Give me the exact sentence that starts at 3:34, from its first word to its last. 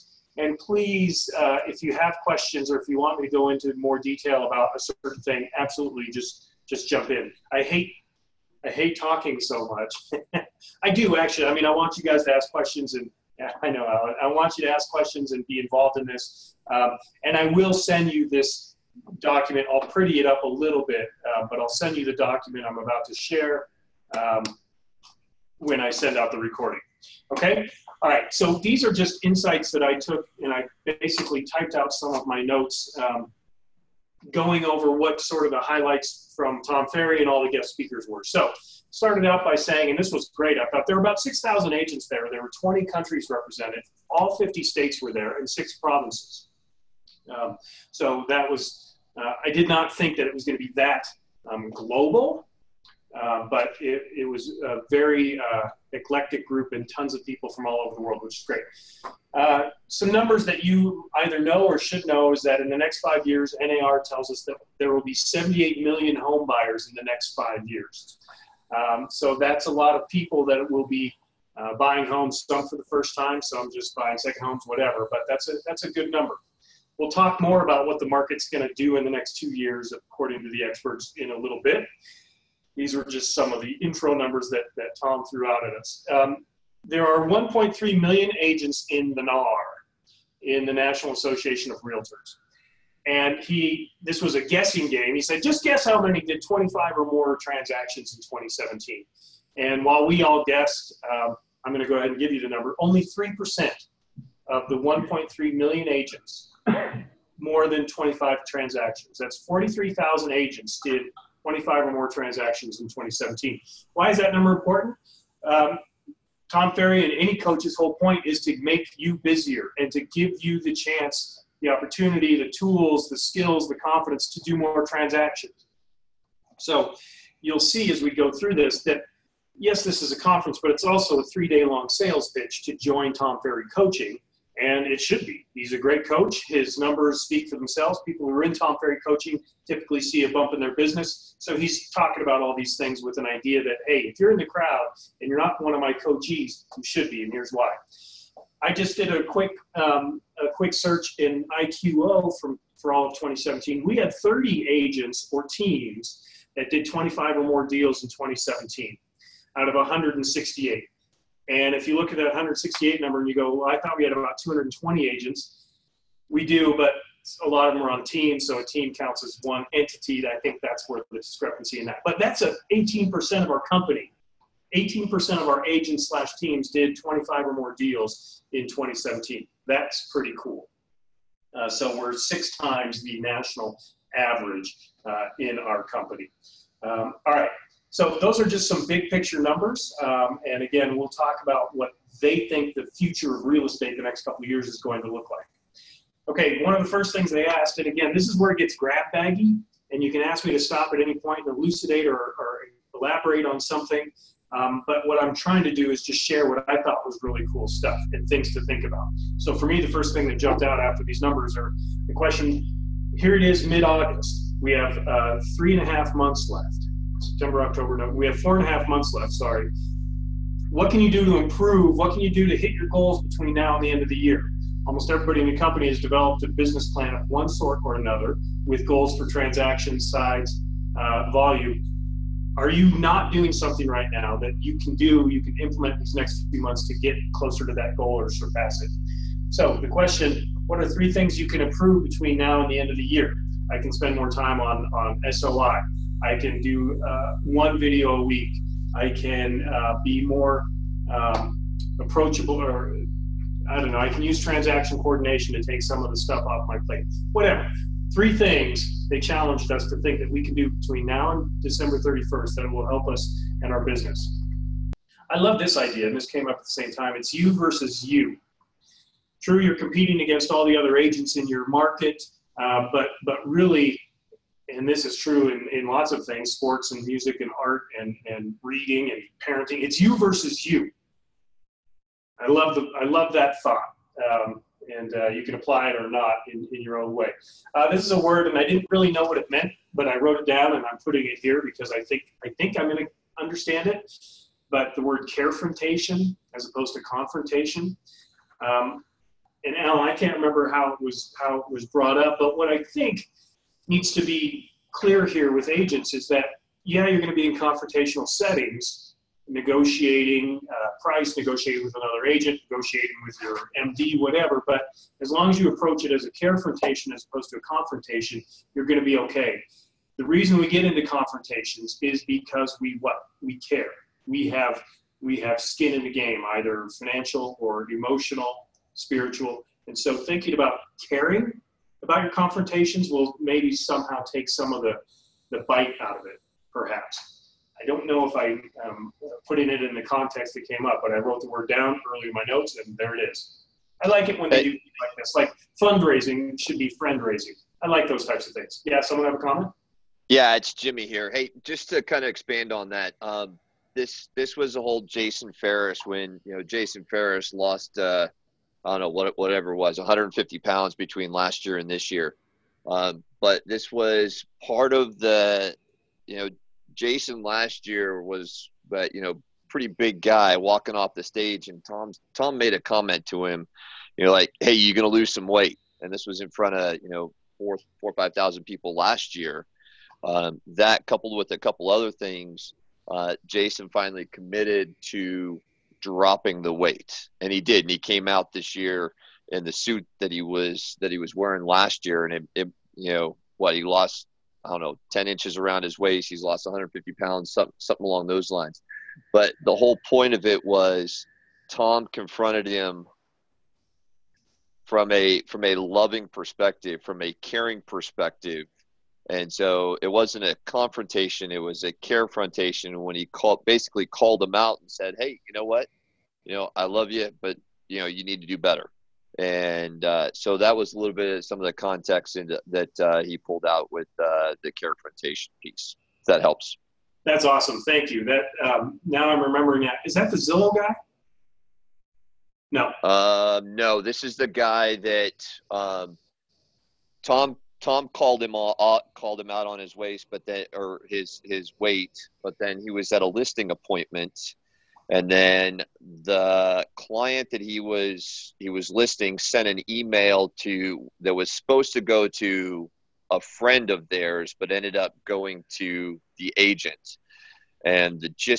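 We have uh, three and a half months left.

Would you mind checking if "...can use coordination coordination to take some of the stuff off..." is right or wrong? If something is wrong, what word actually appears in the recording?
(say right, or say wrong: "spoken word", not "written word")
wrong: "transaction", not "coordination".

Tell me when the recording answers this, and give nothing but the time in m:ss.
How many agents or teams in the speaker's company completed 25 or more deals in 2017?
2:34.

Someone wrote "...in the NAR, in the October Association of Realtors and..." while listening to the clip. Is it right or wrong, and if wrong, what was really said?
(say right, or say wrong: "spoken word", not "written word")
wrong: "National", not "October".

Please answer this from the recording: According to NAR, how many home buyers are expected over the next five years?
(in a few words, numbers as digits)
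78 million.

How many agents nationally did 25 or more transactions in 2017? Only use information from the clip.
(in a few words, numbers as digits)
43,000.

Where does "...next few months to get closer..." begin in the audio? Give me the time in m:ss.
3:56.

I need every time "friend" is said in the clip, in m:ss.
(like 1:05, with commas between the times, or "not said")
5:46, 7:33.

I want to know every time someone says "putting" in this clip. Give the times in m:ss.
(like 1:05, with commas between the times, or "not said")
4:51, 5:39.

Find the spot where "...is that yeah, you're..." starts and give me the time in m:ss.
5:06.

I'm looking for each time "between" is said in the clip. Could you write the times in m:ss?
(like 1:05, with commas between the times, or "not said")
3:43, 4:02, 4:20, 6:00.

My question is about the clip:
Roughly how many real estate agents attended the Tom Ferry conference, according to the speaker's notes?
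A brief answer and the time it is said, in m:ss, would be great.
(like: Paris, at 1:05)
6,000, at 0:41.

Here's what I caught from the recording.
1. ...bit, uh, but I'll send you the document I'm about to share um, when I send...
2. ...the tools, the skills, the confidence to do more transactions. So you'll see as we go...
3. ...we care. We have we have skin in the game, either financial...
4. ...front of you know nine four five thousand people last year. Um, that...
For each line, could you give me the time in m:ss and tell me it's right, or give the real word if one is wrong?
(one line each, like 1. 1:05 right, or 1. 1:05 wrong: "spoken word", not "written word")
1. 0:20 right
2. 2:02 right
3. 5:23 right
4. 6:16 wrong: "four", not "nine".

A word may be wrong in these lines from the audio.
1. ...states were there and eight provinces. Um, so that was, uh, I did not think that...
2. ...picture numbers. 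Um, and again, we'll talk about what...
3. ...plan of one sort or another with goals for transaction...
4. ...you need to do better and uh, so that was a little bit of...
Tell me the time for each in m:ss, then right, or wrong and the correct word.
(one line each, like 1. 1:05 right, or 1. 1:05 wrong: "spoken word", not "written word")
1. 0:44 wrong: "six", not "eight"
2. 3:09 right
3. 3:46 right
4. 6:58 right.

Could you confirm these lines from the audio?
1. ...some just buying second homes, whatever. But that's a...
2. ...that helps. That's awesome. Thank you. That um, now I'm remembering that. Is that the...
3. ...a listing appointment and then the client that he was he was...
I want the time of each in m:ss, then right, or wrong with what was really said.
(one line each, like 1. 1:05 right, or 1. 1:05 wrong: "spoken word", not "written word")
1. 1:13 right
2. 7:06 right
3. 7:23 right.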